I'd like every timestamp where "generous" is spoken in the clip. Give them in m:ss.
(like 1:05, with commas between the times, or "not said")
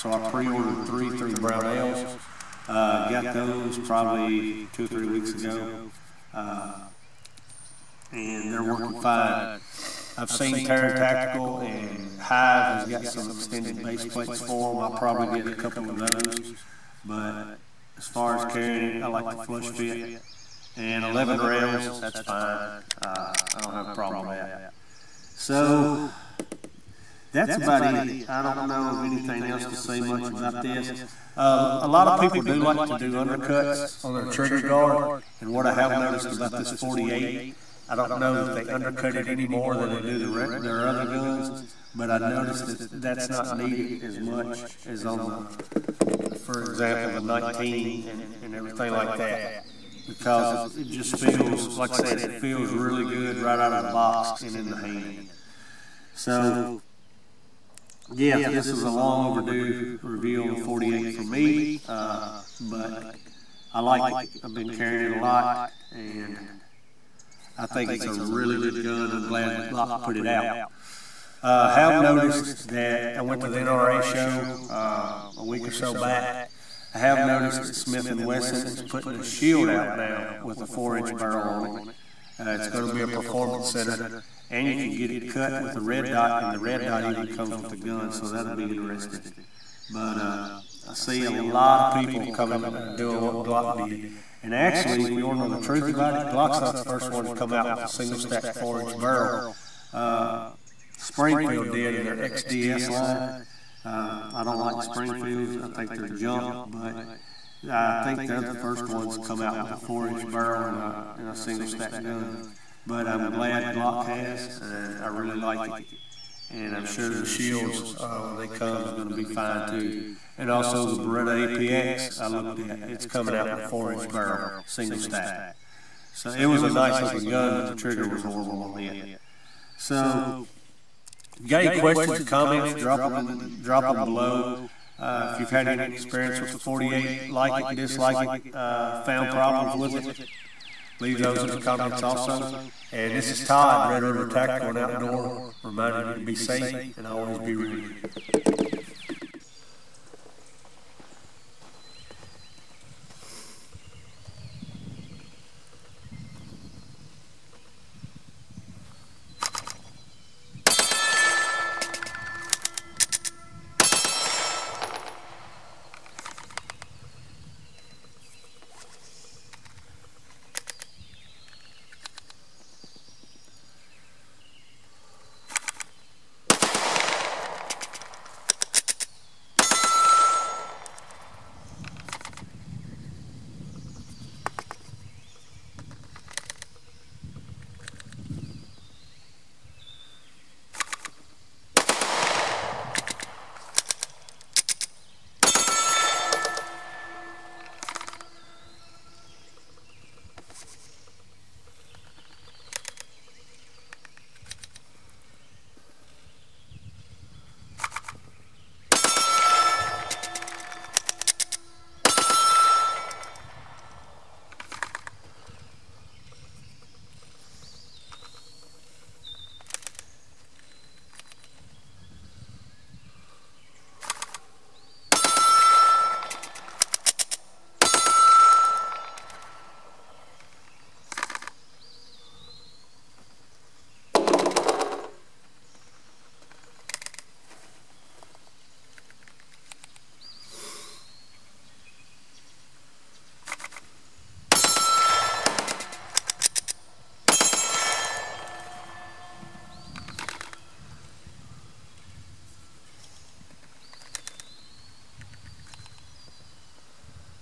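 not said.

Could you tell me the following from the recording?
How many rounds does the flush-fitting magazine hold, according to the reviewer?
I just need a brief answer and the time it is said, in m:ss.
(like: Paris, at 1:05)
11, at 0:21.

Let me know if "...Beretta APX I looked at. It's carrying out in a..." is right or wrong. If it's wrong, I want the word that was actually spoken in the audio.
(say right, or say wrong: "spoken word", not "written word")
wrong: "coming", not "carrying".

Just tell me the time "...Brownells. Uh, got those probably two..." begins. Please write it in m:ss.
0:01.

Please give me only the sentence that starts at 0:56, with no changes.
So, yeah, this is a long overdue review on the 48 for me, uh, but I like it.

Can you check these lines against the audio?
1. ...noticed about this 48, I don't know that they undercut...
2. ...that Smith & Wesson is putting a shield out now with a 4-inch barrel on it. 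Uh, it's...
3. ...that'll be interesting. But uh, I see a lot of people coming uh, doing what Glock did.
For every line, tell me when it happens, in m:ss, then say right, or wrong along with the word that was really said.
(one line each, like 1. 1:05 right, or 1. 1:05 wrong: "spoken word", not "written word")
1. 0:35 right
2. 1:17 right
3. 1:28 right.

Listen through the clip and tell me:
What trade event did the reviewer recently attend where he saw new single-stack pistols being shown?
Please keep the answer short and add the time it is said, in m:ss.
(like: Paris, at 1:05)
NRA show, at 1:13.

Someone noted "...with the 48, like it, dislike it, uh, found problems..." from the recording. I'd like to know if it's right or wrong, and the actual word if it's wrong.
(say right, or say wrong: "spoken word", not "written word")
right.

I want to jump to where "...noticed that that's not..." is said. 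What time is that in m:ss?
0:42.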